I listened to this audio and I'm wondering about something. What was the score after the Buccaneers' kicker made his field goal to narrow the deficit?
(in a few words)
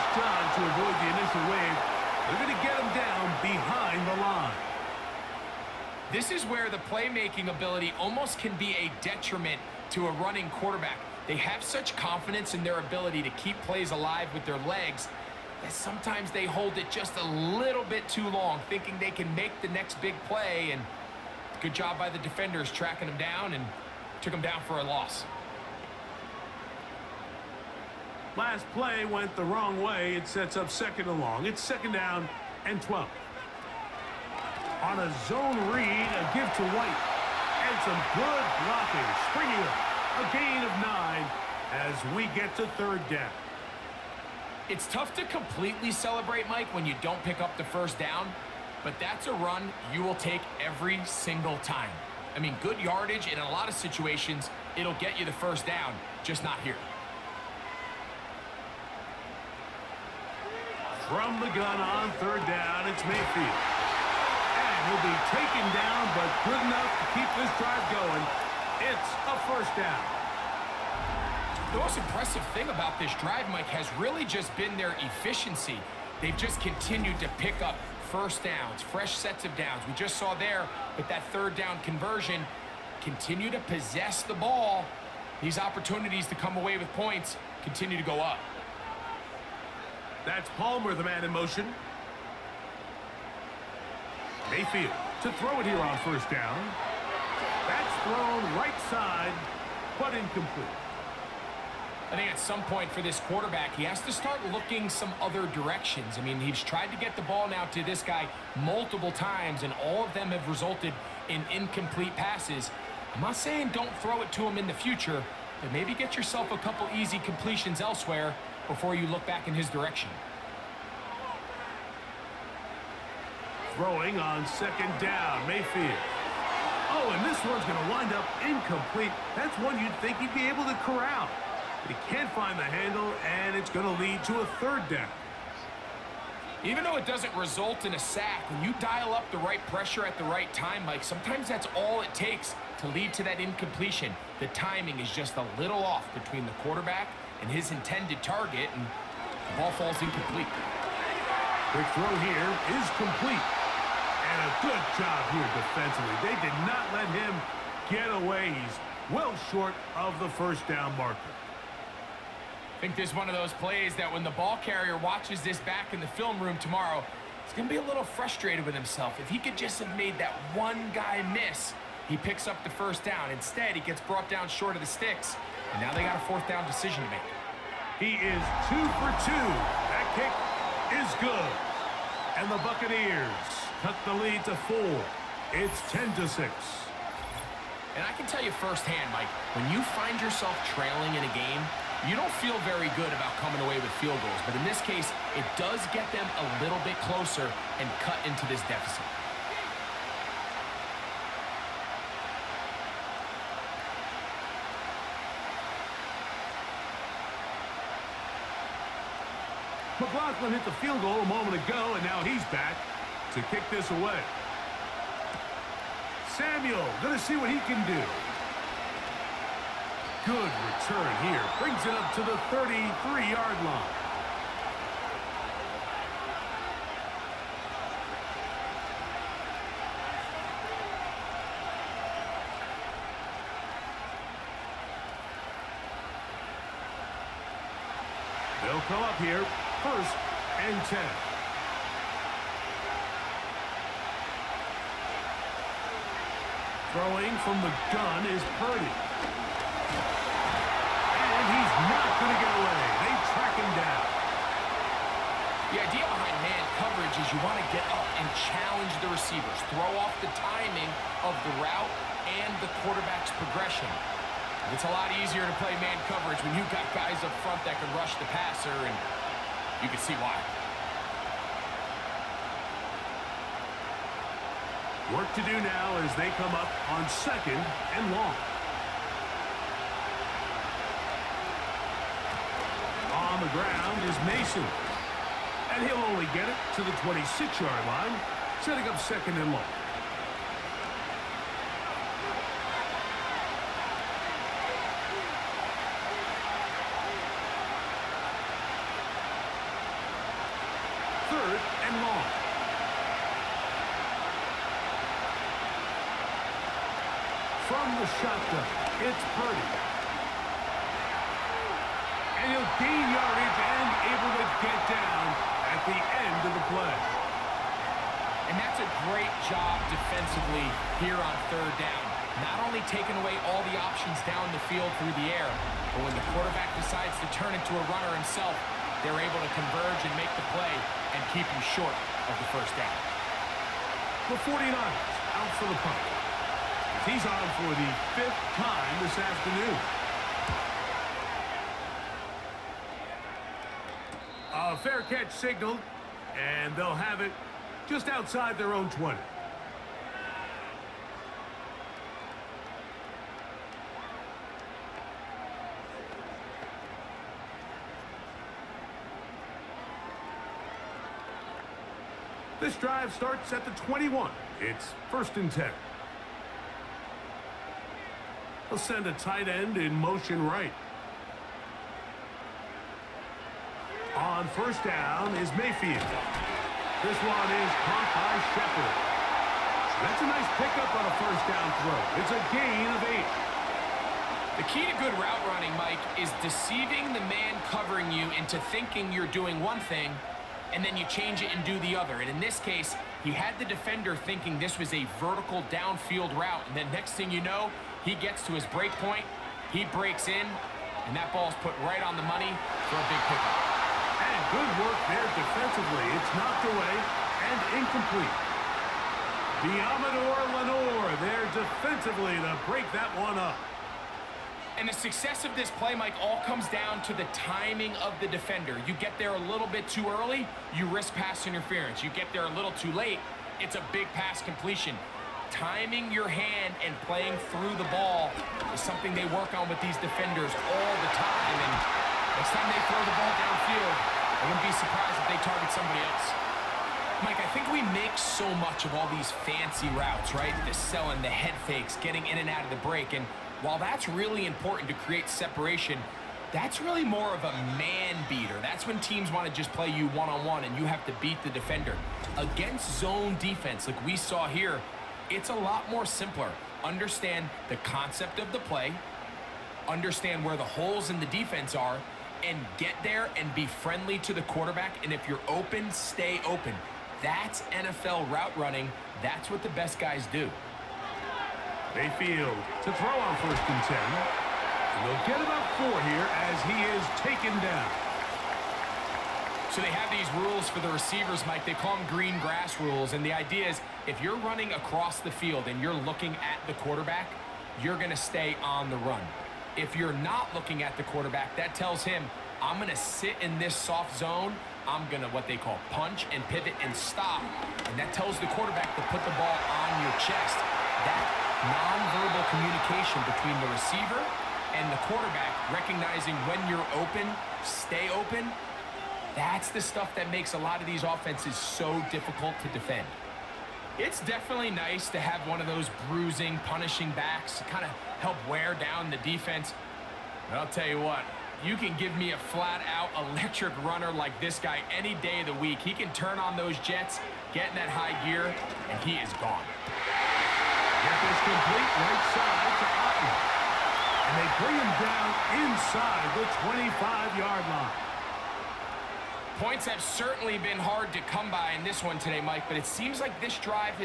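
10 to 6.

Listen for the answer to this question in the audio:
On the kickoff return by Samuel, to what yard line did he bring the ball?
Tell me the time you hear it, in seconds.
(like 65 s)
222 s.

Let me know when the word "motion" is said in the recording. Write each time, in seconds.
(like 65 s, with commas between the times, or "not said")
91 s, 369 s.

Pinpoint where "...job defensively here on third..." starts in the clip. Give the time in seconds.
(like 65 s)
319 s.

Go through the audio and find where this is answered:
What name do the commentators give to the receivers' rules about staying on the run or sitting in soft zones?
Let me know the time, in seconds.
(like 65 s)
482 s.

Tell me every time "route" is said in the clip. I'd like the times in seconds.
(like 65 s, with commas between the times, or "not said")
261 s, 385 s, 396 s, 439 s, 468 s.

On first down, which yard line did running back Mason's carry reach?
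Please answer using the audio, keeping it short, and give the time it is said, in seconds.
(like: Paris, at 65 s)
26-yard line, at 287 s.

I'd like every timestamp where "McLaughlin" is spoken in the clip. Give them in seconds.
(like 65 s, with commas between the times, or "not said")
209 s.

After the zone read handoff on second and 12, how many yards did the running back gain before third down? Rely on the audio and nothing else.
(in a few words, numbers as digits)
9.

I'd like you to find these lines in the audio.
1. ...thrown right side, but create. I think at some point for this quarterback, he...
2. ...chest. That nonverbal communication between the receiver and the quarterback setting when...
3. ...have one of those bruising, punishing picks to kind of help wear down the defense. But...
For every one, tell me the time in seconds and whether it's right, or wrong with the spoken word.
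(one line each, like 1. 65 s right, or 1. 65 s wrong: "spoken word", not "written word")
1. 98 s wrong: "incomplete", not "create"
2. 500 s wrong: "recognizing", not "setting"
3. 515 s wrong: "backs", not "picks".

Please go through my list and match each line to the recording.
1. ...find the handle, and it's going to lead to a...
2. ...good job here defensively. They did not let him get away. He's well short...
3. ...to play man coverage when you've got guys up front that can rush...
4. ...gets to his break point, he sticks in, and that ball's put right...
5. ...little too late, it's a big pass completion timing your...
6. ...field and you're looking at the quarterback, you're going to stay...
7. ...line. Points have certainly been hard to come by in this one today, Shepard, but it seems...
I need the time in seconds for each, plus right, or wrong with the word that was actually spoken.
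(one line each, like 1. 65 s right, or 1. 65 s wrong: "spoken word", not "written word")
1. 132 s right
2. 154 s right
3. 265 s right
4. 398 s wrong: "breaks", not "sticks"
5. 422 s right
6. 485 s right
7. 537 s wrong: "Mike", not "Shepard".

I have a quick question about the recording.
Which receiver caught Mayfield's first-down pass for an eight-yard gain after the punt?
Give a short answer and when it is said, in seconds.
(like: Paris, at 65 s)
Shepard, at 378 s.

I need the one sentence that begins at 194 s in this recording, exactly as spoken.
But in this case, it does get them a little bit closer and cut into this deficit.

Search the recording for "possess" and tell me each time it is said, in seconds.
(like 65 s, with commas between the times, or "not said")
83 s.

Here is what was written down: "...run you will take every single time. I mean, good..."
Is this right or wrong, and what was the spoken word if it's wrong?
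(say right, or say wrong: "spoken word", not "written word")
right.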